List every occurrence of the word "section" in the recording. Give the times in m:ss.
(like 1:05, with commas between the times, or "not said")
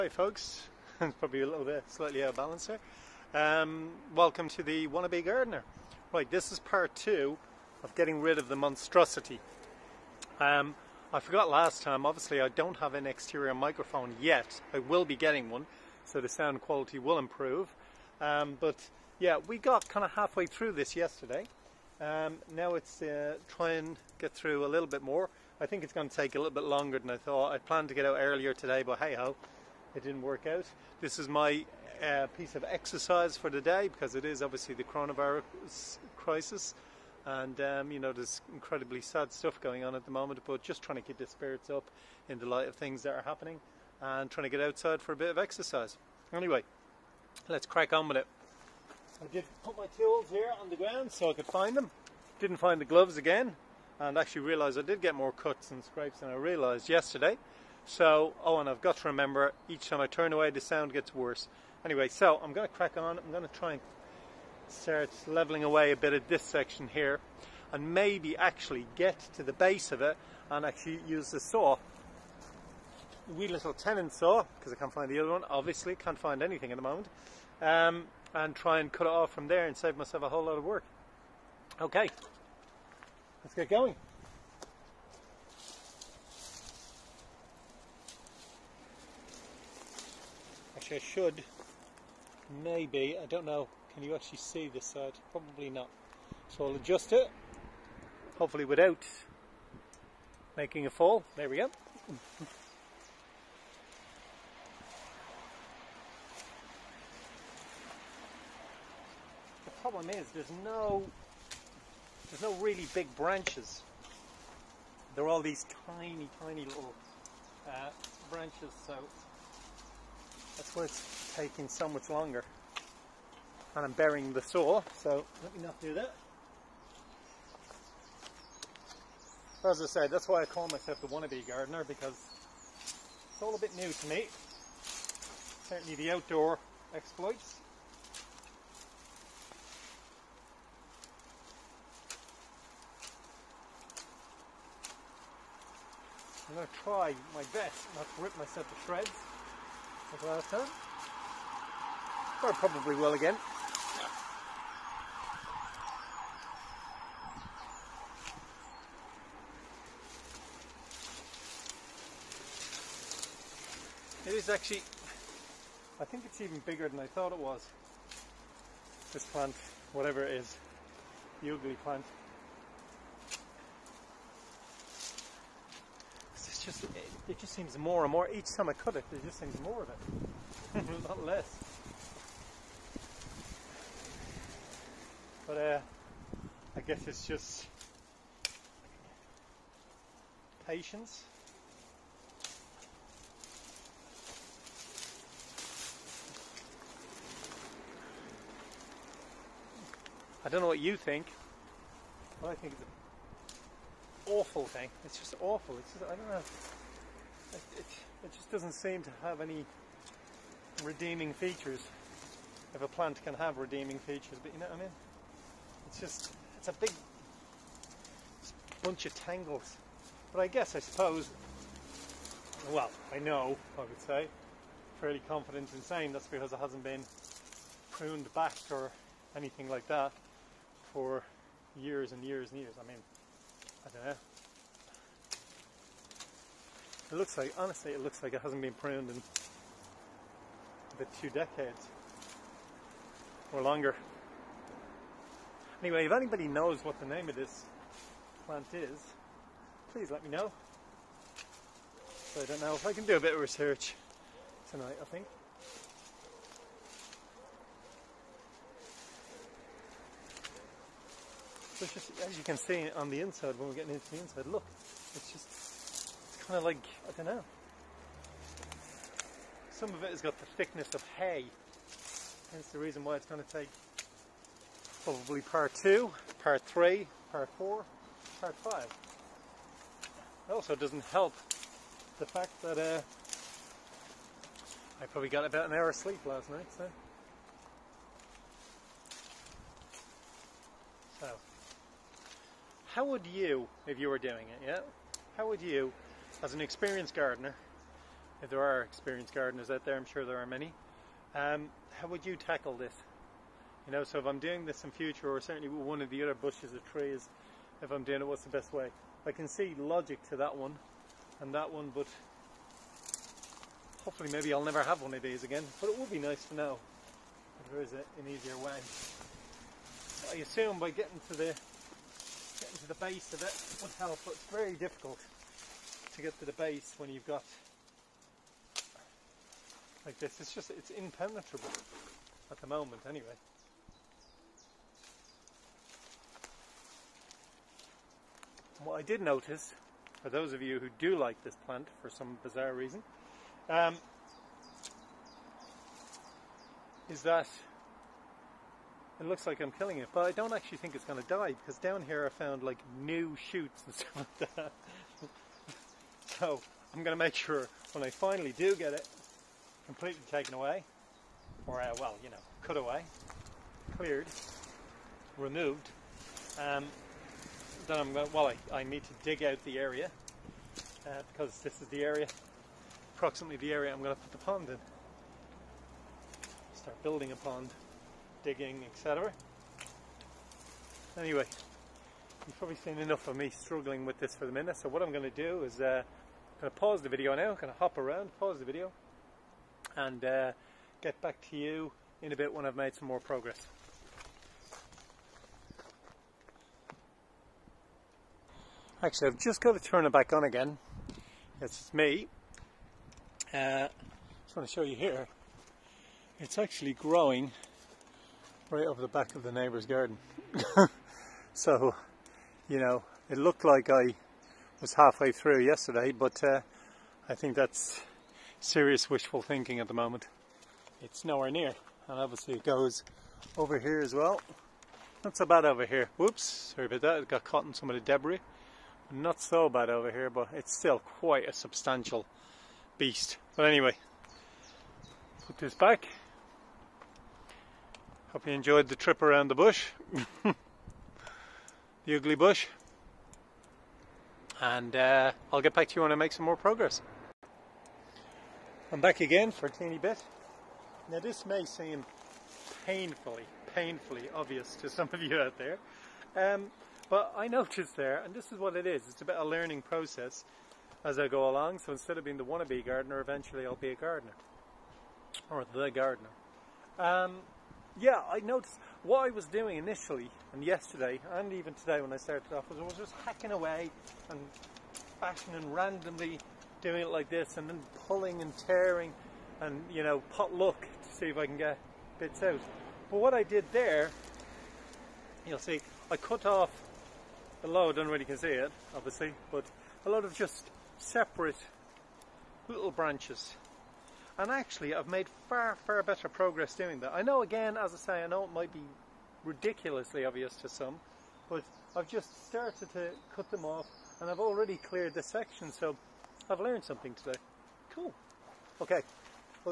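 1:06, 8:25.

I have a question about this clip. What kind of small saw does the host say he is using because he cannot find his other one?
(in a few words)
Tenon saw.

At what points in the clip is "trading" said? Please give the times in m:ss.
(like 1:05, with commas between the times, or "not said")
not said.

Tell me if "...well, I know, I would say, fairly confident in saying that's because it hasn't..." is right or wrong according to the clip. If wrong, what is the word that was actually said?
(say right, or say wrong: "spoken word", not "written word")
right.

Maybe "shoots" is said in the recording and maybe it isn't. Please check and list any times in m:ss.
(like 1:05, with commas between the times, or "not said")
5:53.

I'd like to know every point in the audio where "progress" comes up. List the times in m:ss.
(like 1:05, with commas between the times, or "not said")
6:33, 7:26, 8:16.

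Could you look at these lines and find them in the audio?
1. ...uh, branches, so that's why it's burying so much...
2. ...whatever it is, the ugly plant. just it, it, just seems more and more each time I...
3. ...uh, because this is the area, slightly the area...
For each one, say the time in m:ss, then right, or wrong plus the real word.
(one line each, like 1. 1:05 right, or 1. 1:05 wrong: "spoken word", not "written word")
1. 1:57 wrong: "taking", not "burying"
2. 2:49 right
3. 6:11 wrong: "approximately", not "slightly".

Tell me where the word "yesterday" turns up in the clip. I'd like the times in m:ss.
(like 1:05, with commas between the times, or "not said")
0:20, 0:56, 6:55, 7:50.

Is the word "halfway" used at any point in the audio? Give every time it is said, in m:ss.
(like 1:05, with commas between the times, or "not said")
0:20, 6:54.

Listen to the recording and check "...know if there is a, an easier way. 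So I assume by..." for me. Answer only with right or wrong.
right.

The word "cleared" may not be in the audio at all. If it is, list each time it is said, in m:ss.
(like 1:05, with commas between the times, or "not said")
6:03, 8:24.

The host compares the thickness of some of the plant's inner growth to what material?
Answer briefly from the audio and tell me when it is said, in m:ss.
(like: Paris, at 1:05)
Hay, at 4:31.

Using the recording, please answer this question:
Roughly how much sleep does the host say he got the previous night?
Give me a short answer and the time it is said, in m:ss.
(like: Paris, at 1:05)
An hour, at 4:45.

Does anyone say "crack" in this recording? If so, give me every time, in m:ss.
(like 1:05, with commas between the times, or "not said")
0:47, 1:02.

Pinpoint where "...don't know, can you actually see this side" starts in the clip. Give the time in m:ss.
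1:33.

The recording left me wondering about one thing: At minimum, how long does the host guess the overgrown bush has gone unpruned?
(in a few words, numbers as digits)
Two decades.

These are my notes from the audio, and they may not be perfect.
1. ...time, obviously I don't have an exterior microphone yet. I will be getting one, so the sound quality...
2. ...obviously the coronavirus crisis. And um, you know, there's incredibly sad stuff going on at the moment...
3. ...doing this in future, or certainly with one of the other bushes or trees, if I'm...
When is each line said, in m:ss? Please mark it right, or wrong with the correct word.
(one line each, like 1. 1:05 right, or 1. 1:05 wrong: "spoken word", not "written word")
1. 0:11 right
2. 0:34 right
3. 5:04 right.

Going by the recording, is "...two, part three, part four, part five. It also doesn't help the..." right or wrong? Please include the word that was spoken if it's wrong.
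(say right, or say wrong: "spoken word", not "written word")
right.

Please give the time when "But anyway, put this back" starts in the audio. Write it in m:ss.
7:13.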